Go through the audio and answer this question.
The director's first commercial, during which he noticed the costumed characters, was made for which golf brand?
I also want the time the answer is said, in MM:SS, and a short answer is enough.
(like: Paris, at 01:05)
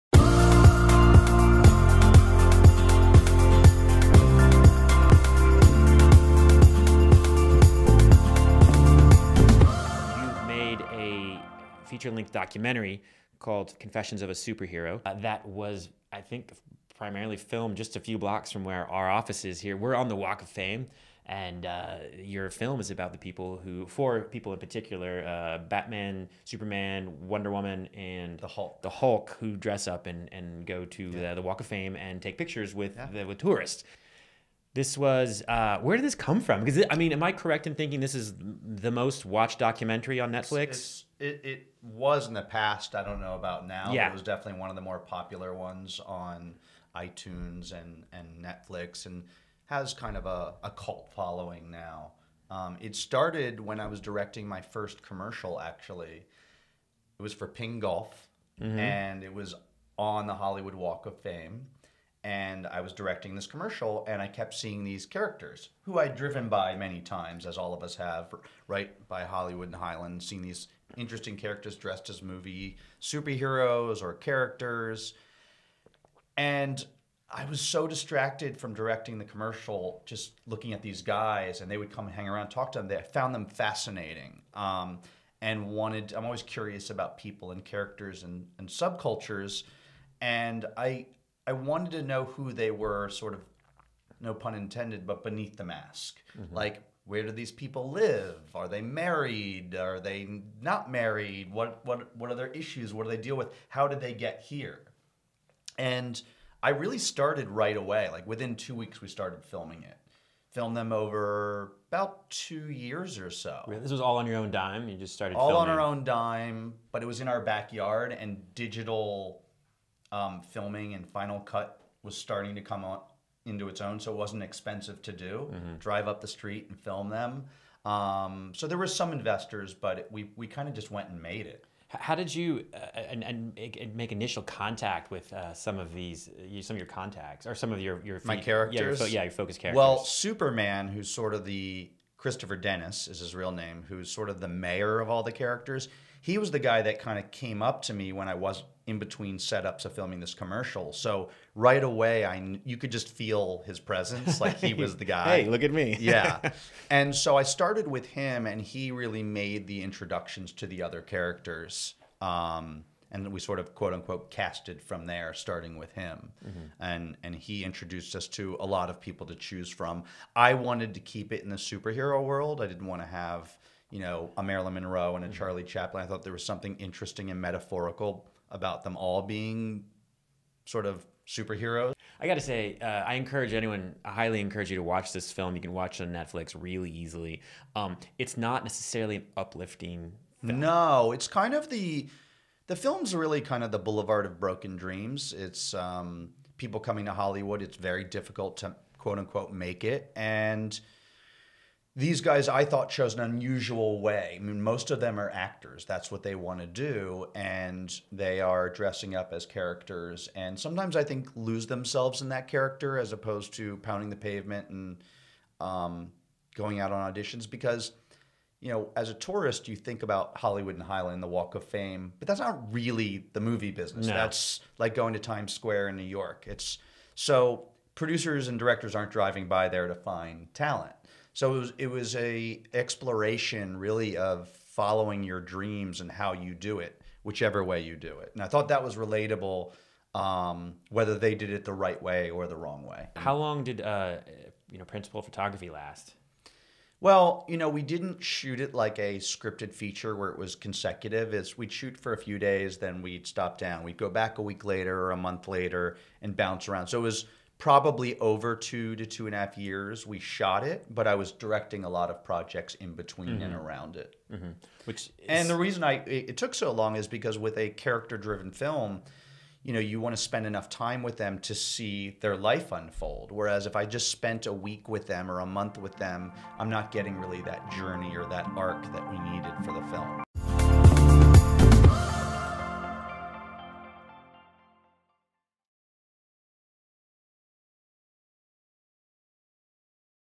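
Ping Golf, at 00:57.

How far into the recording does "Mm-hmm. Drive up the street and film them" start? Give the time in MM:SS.
02:05.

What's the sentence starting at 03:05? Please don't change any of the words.
You can watch it on Netflix really easily.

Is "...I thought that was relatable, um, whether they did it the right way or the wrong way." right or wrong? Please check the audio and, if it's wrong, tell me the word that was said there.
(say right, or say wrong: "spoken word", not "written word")
right.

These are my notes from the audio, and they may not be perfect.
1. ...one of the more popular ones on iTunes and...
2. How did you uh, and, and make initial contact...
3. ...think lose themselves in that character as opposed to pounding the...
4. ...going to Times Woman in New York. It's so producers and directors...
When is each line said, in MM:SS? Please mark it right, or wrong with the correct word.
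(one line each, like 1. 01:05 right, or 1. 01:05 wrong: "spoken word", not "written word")
1. 00:44 right
2. 02:11 right
3. 03:31 right
4. 03:44 wrong: "Square", not "Woman".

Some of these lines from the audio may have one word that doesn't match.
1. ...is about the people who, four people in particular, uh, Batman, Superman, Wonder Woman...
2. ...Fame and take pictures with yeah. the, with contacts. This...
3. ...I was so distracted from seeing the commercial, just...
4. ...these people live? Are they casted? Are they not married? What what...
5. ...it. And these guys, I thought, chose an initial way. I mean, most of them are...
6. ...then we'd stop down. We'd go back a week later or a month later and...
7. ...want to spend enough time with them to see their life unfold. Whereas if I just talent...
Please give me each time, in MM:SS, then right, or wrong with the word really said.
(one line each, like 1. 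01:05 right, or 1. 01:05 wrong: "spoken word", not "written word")
1. 00:22 right
2. 00:31 wrong: "tourists", not "contacts"
3. 01:17 wrong: "directing", not "seeing"
4. 01:37 wrong: "married", not "casted"
5. 03:19 wrong: "unusual", not "initial"
6. 04:12 right
7. 04:30 wrong: "spent", not "talent".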